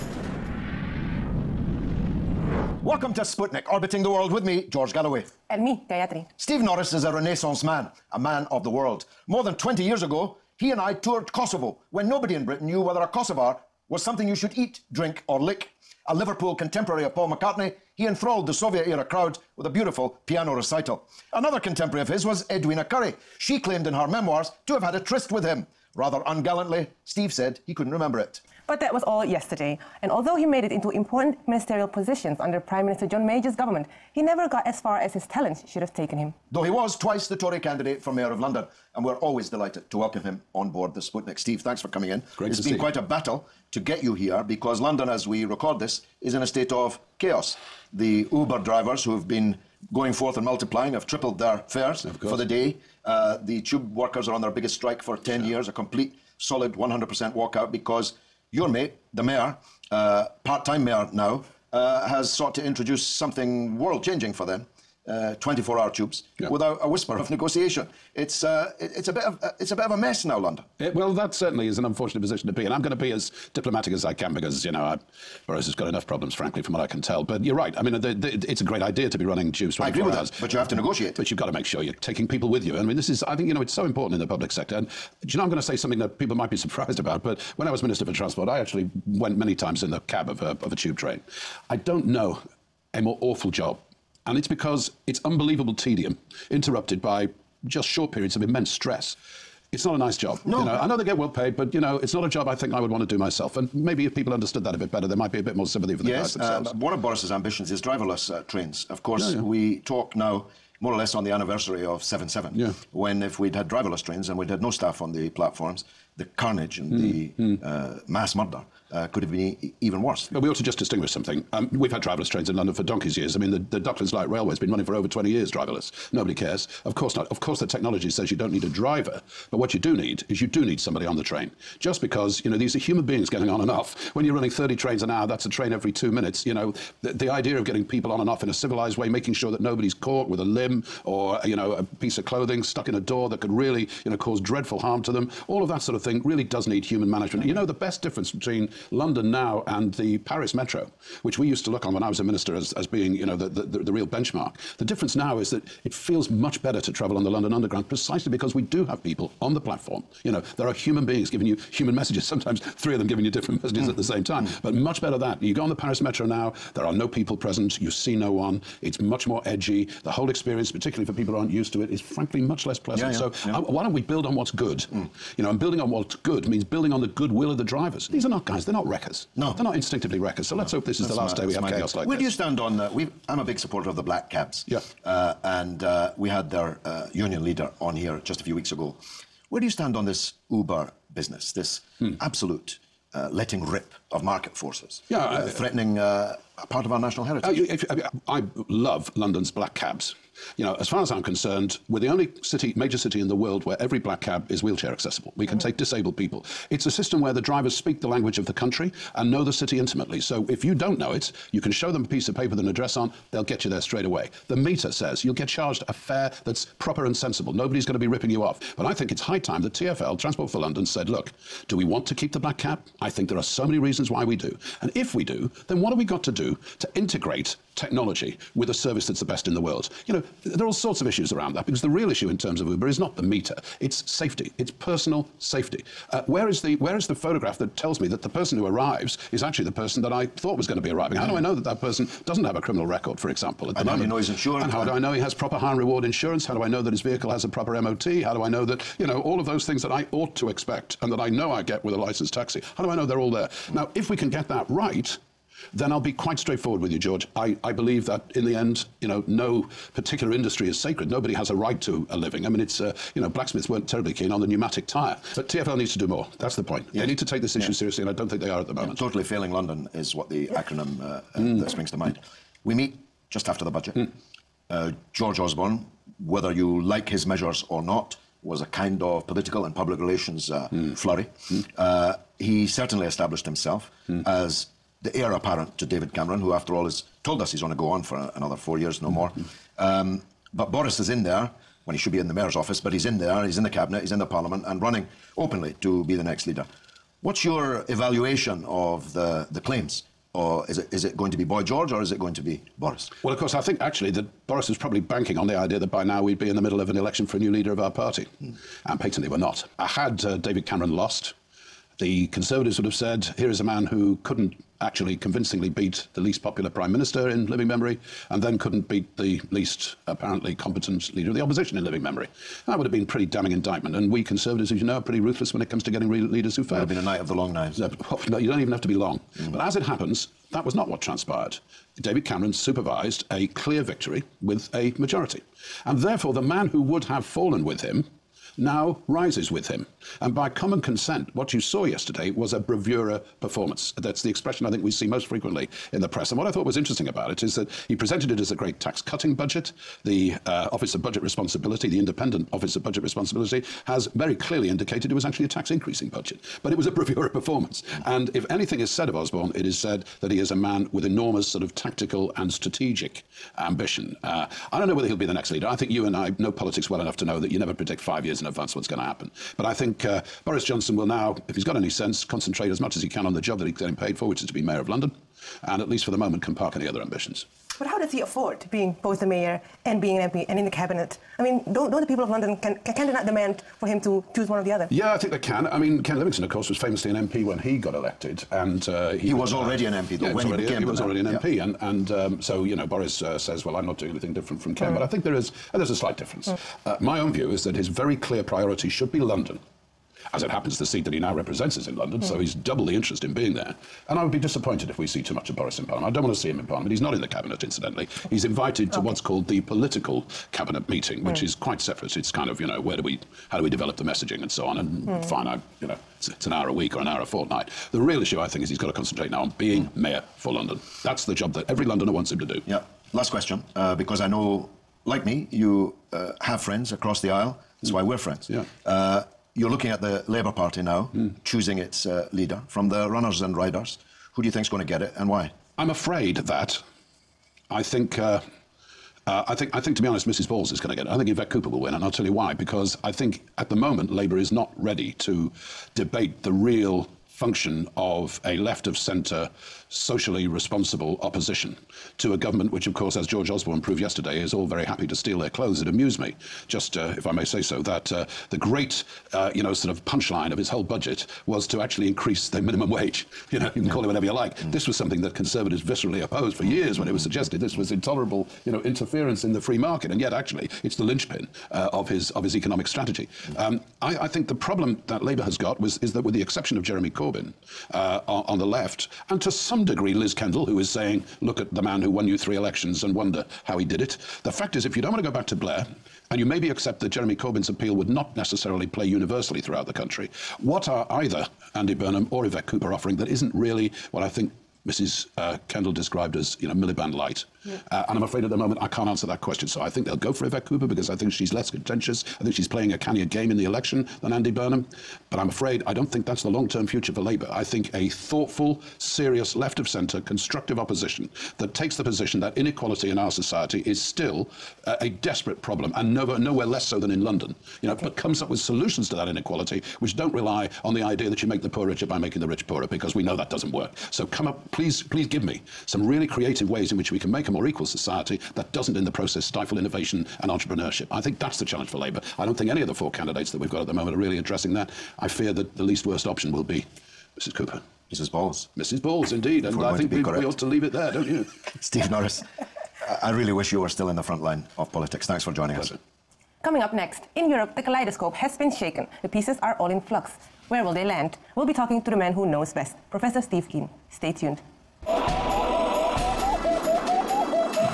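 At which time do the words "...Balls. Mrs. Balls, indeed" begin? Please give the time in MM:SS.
08:58.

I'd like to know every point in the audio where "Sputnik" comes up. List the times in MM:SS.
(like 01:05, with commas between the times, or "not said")
00:03, 00:41.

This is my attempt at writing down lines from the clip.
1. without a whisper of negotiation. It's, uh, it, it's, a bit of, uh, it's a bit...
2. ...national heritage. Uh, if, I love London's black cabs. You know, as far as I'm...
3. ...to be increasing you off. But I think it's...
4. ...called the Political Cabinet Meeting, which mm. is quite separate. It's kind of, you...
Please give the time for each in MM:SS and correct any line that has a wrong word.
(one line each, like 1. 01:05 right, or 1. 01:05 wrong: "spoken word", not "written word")
1. 01:06 right
2. 03:16 right
3. 03:37 wrong: "ripping", not "increasing"
4. 06:49 right.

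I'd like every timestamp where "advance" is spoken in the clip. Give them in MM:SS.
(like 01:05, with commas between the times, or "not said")
06:08.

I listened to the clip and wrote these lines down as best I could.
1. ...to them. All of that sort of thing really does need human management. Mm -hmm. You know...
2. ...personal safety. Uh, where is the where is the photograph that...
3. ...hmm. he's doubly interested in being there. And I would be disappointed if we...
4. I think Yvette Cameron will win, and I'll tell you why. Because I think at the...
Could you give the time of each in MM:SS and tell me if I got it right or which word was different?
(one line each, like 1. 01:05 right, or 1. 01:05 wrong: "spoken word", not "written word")
1. 02:25 right
2. 03:54 right
3. 06:42 right
4. 07:21 wrong: "Cooper", not "Cameron".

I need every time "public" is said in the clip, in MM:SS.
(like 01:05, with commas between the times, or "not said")
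01:24, 04:39.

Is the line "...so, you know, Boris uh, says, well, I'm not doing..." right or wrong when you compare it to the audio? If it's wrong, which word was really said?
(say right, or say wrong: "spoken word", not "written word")
right.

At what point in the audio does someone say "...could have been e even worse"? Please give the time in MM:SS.
01:59.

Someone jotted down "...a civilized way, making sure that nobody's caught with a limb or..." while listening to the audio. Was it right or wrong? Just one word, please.
right.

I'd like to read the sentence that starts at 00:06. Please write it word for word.
Steve Norris is a Renaissance man, a man of the world.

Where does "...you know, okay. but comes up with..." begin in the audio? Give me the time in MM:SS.
08:37.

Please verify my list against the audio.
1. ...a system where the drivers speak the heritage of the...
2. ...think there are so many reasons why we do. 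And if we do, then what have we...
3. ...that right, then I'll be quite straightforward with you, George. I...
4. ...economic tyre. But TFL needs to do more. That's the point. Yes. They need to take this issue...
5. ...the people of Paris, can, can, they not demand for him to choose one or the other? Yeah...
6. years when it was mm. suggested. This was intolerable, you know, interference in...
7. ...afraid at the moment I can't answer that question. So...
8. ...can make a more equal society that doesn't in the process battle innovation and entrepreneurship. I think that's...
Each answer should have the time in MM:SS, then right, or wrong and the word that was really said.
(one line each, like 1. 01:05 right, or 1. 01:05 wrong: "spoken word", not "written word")
1. 03:26 wrong: "language", not "heritage"
2. 03:43 right
3. 04:14 right
4. 04:24 wrong: "pneumatic", not "economic"
5. 06:22 wrong: "London", not "Paris"
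6. 07:46 right
7. 08:18 right
8. 08:47 wrong: "stifle", not "battle".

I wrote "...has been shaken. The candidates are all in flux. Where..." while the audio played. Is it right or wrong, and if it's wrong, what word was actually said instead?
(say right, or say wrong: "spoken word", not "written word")
wrong: "pieces", not "candidates".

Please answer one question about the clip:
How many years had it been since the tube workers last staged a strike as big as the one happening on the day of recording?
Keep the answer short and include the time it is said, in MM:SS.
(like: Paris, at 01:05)
10, at 00:55.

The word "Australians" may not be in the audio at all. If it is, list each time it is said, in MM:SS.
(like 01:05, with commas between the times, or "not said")
not said.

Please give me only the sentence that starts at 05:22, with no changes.
That would have been pretty damning indictment.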